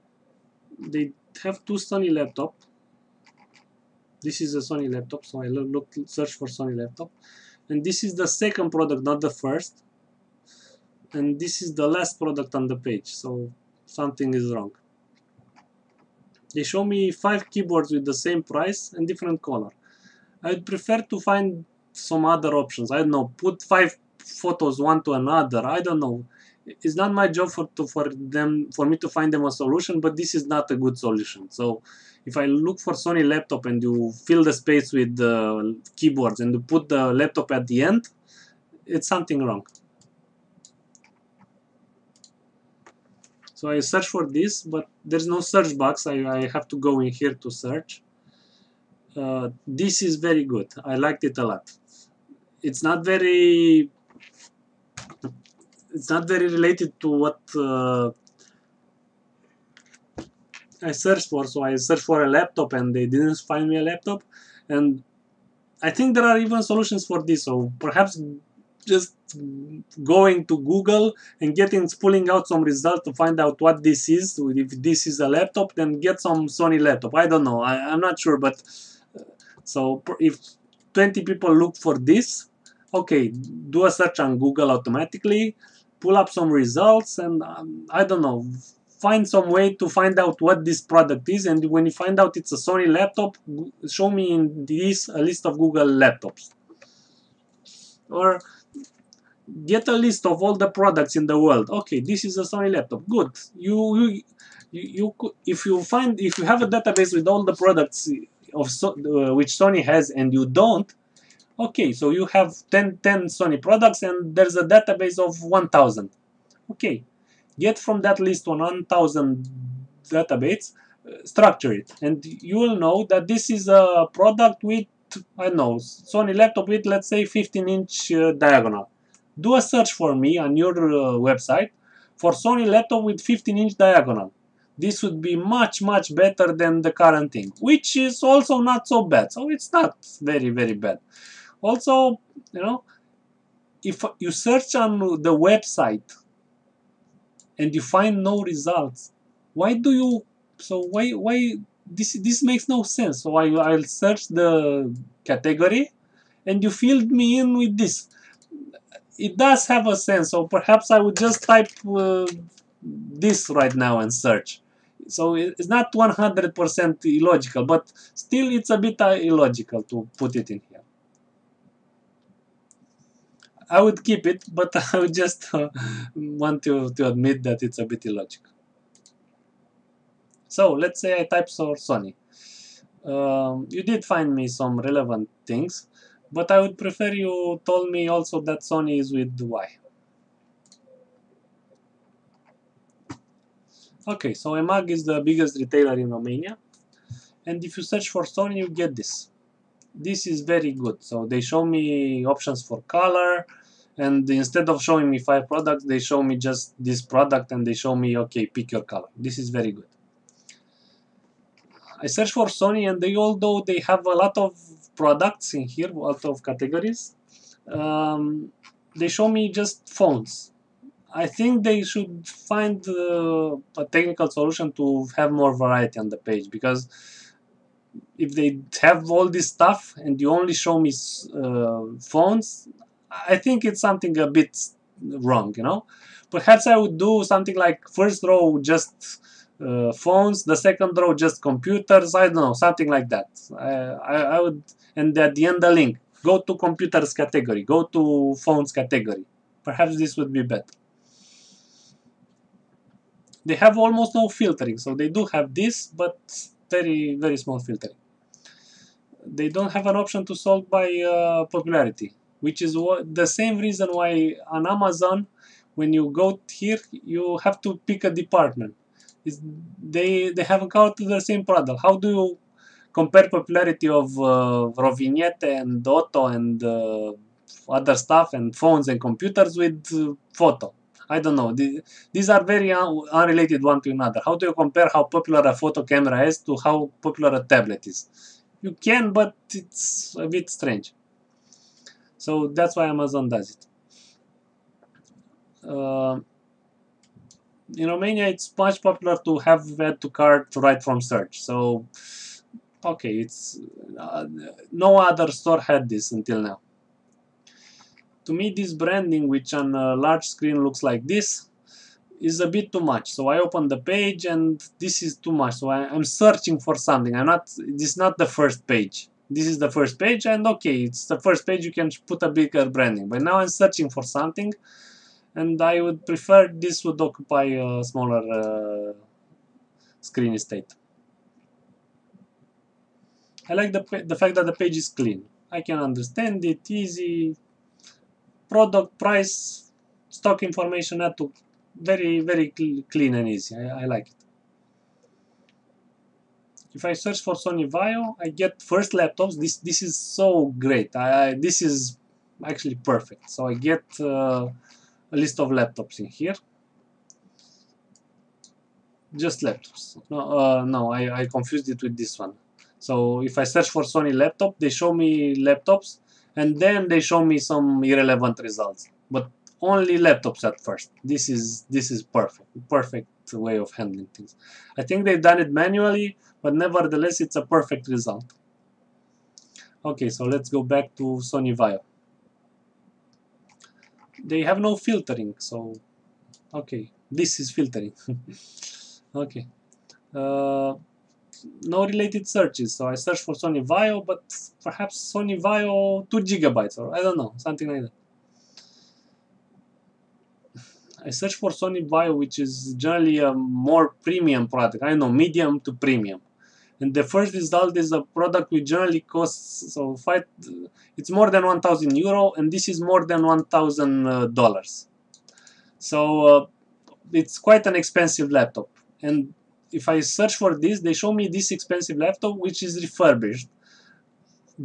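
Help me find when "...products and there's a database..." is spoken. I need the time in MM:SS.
01:53.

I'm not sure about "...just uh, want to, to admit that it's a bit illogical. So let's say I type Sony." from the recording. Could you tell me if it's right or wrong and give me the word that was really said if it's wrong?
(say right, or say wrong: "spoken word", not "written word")
right.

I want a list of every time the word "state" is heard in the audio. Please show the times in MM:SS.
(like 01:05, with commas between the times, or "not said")
05:30.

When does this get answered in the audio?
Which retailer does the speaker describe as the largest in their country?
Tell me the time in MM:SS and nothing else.
03:14.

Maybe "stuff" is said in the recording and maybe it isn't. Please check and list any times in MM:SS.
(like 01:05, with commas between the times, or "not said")
03:49, 04:37.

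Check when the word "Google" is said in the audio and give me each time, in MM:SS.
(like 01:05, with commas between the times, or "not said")
01:10, 01:24, 01:35.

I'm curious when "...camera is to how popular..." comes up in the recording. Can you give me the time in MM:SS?
04:45.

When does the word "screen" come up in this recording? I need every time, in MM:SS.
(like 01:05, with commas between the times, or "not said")
05:10, 05:30.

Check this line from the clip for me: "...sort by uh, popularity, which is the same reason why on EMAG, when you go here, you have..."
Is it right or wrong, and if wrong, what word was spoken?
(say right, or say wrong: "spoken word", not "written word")
wrong: "Amazon", not "EMAG".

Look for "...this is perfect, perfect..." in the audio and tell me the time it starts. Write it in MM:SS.
06:11.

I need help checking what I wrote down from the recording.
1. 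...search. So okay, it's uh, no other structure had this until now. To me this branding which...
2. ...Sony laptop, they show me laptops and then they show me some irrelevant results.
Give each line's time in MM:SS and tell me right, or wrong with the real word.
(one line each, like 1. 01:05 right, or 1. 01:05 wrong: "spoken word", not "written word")
1. 05:01 wrong: "store", not "structure"
2. 06:03 right.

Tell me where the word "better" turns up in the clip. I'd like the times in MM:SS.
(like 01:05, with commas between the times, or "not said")
02:16, 04:10.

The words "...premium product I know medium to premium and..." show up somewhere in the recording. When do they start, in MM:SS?
06:44.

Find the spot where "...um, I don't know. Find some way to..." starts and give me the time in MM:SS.
01:27.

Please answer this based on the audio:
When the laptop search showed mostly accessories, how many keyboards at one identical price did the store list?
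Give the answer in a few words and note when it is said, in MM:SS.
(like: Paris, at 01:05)
5, at 00:17.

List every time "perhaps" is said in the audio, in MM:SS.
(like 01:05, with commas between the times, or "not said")
01:07, 02:40, 03:56, 04:09, 06:34.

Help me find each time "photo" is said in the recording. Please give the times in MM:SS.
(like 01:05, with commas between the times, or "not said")
00:24, 04:40, 04:45.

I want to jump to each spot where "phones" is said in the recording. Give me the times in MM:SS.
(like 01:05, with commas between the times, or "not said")
03:39, 03:52, 03:59, 04:08, 04:38.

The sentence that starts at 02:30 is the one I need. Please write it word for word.
So why why this this makes no sense.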